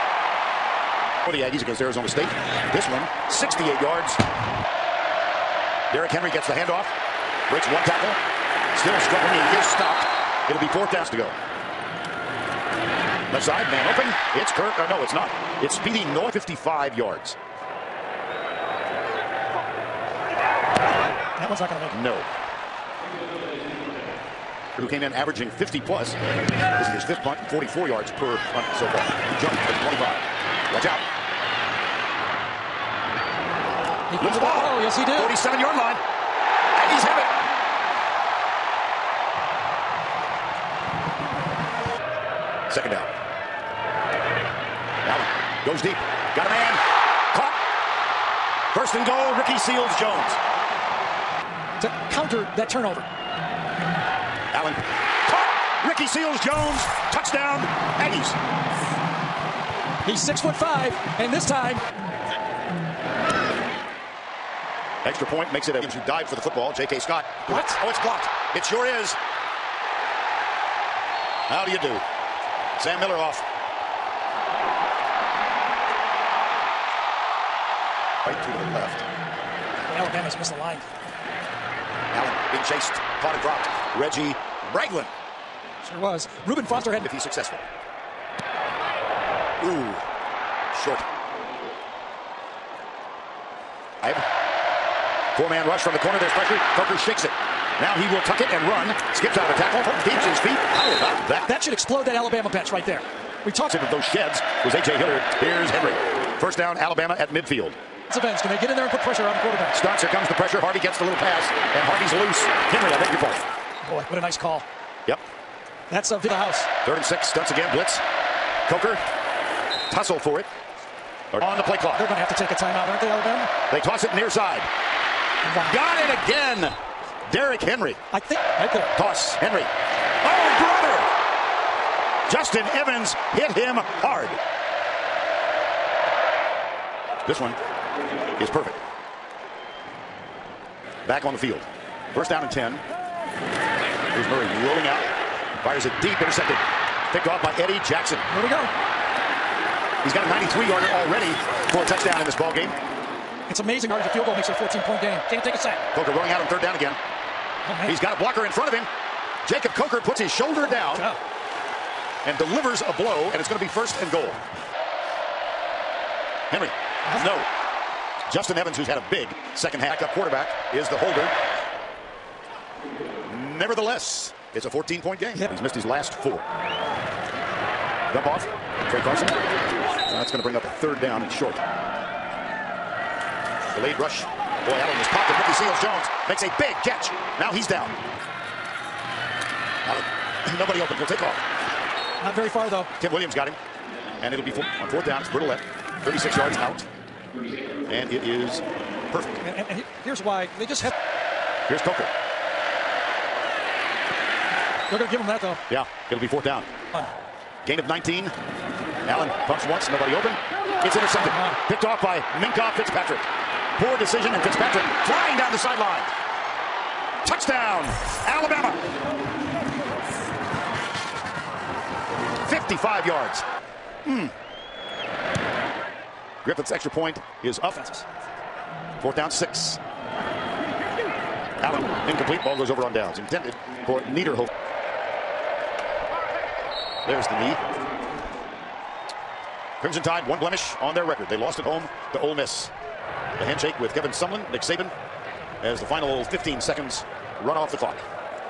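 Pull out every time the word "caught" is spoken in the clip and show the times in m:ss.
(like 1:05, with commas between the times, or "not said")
0:47, 0:55, 1:23.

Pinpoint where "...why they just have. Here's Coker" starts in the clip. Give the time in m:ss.
3:20.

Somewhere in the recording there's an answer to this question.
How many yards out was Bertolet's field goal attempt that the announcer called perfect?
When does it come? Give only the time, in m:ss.
3:16.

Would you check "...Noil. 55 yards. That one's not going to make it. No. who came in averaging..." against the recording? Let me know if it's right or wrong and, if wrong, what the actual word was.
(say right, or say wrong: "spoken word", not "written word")
right.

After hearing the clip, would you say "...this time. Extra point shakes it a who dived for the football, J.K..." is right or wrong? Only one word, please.
wrong.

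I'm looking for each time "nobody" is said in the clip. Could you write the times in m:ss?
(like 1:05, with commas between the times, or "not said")
3:10, 3:29.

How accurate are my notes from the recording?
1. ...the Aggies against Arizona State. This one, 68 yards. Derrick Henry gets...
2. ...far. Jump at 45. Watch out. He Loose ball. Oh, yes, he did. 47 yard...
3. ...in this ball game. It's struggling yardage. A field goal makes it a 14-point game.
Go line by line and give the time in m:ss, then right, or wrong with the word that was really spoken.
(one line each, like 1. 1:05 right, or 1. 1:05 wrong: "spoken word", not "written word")
1. 0:01 right
2. 0:28 wrong: "25", not "45"
3. 2:32 wrong: "amazing", not "struggling".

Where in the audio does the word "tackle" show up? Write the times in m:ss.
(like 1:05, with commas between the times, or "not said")
0:07, 1:39.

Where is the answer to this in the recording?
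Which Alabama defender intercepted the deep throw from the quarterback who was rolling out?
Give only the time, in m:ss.
2:27.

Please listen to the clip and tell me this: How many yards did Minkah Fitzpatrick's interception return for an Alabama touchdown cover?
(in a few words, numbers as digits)
55.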